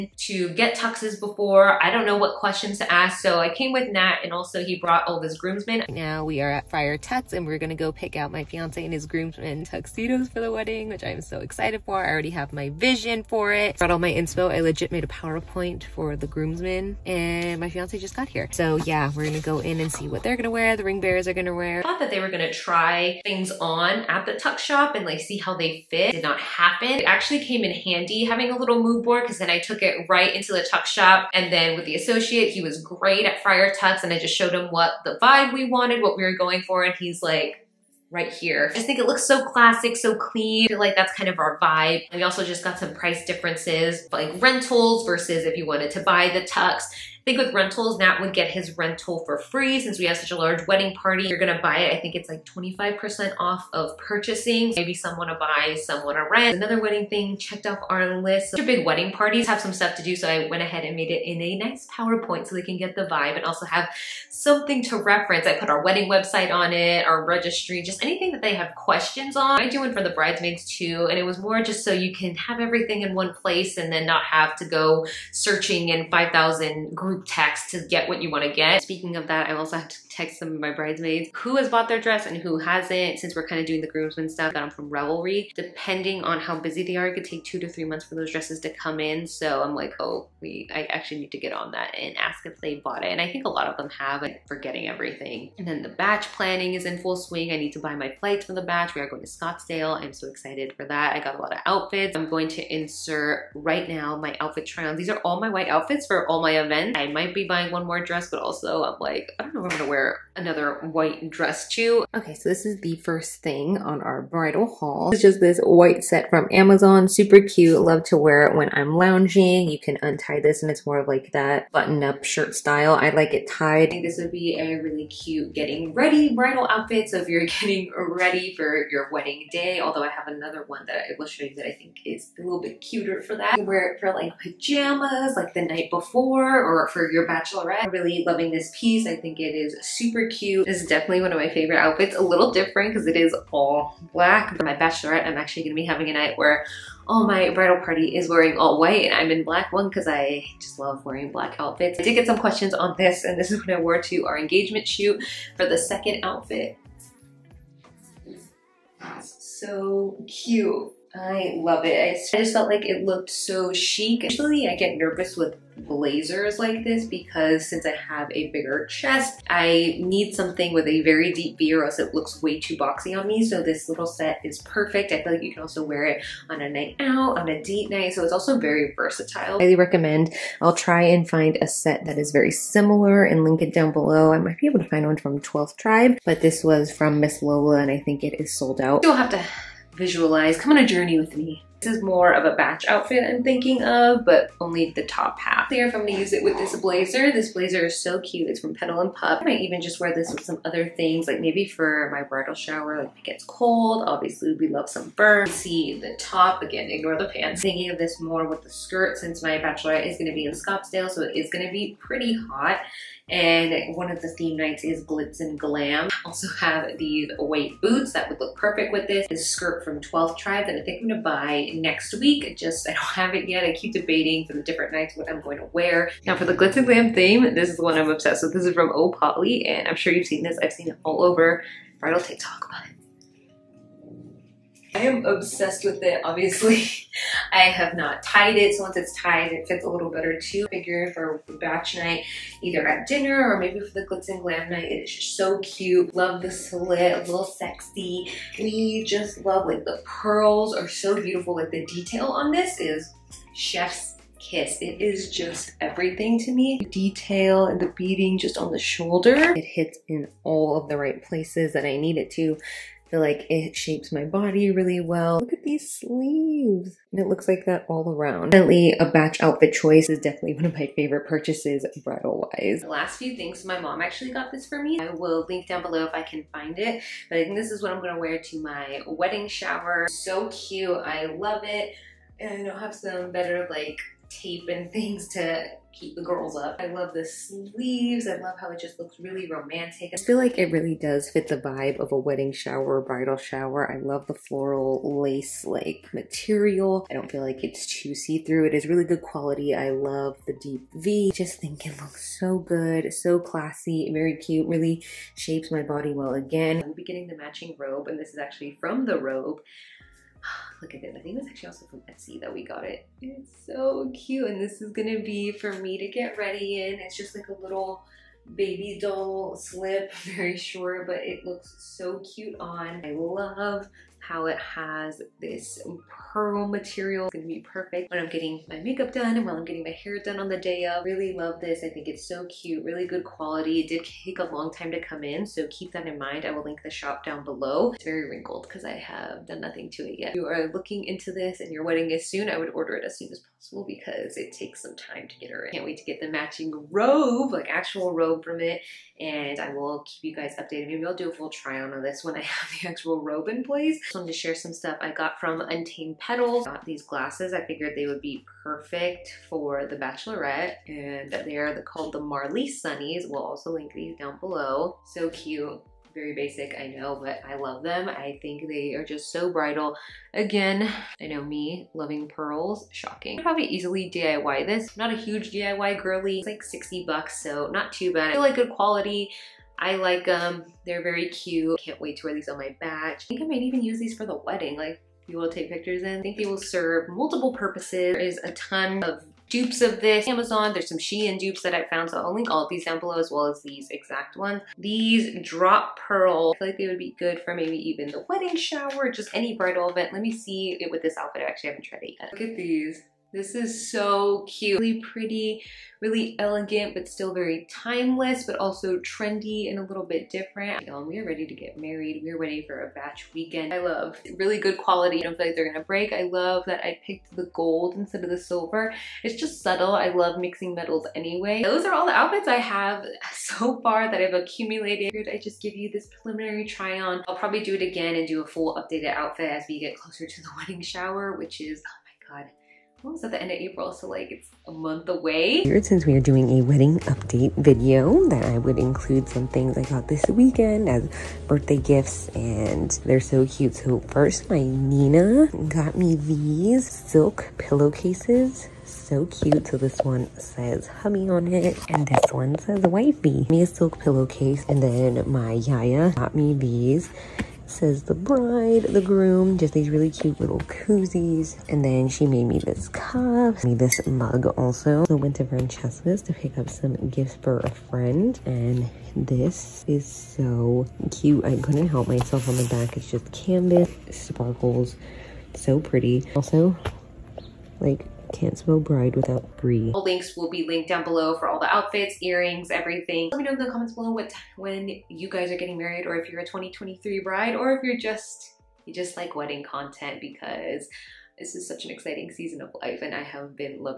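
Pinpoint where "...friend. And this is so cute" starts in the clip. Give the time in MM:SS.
07:47.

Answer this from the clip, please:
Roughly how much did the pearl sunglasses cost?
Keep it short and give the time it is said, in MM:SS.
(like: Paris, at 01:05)
$60, at 06:16.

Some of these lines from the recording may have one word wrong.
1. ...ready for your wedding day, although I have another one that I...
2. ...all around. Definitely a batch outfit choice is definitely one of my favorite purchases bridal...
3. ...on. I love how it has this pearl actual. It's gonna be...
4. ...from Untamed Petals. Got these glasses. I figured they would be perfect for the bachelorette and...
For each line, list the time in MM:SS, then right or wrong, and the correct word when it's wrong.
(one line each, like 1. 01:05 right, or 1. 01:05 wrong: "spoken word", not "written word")
1. 02:07 right
2. 04:27 right
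3. 05:22 wrong: "material", not "actual"
4. 05:55 right.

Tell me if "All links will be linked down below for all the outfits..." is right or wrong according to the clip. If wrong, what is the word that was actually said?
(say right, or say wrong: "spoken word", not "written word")
right.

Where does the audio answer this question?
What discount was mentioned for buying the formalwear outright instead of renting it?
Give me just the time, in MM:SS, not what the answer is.
00:52.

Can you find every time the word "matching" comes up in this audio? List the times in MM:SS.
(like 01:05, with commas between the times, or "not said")
05:07, 05:46.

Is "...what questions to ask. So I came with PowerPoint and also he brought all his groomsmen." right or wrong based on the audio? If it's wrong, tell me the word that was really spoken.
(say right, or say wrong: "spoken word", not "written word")
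wrong: "Nat", not "PowerPoint".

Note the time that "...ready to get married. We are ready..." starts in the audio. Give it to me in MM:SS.
06:51.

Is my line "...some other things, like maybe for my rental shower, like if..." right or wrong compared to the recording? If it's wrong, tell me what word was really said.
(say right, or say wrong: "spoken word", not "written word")
wrong: "bridal", not "rental".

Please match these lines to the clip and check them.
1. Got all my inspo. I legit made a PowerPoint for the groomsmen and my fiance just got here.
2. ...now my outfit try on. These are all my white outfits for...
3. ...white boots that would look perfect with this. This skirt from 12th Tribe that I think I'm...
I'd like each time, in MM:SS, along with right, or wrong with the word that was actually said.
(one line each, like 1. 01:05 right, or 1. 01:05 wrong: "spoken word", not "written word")
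1. 00:13 right
2. 01:43 right
3. 03:37 right.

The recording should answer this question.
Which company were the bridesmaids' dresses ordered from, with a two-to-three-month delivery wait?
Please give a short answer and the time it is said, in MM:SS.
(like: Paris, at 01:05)
Revelry, at 01:24.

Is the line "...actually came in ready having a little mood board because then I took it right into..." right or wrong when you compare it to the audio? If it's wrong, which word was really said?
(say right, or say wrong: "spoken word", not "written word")
wrong: "handy", not "ready".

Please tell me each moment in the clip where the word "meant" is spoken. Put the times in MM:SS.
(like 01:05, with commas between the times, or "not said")
not said.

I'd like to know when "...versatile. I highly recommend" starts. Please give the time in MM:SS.
02:58.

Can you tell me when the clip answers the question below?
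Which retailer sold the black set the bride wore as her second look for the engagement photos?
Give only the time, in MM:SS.
03:07.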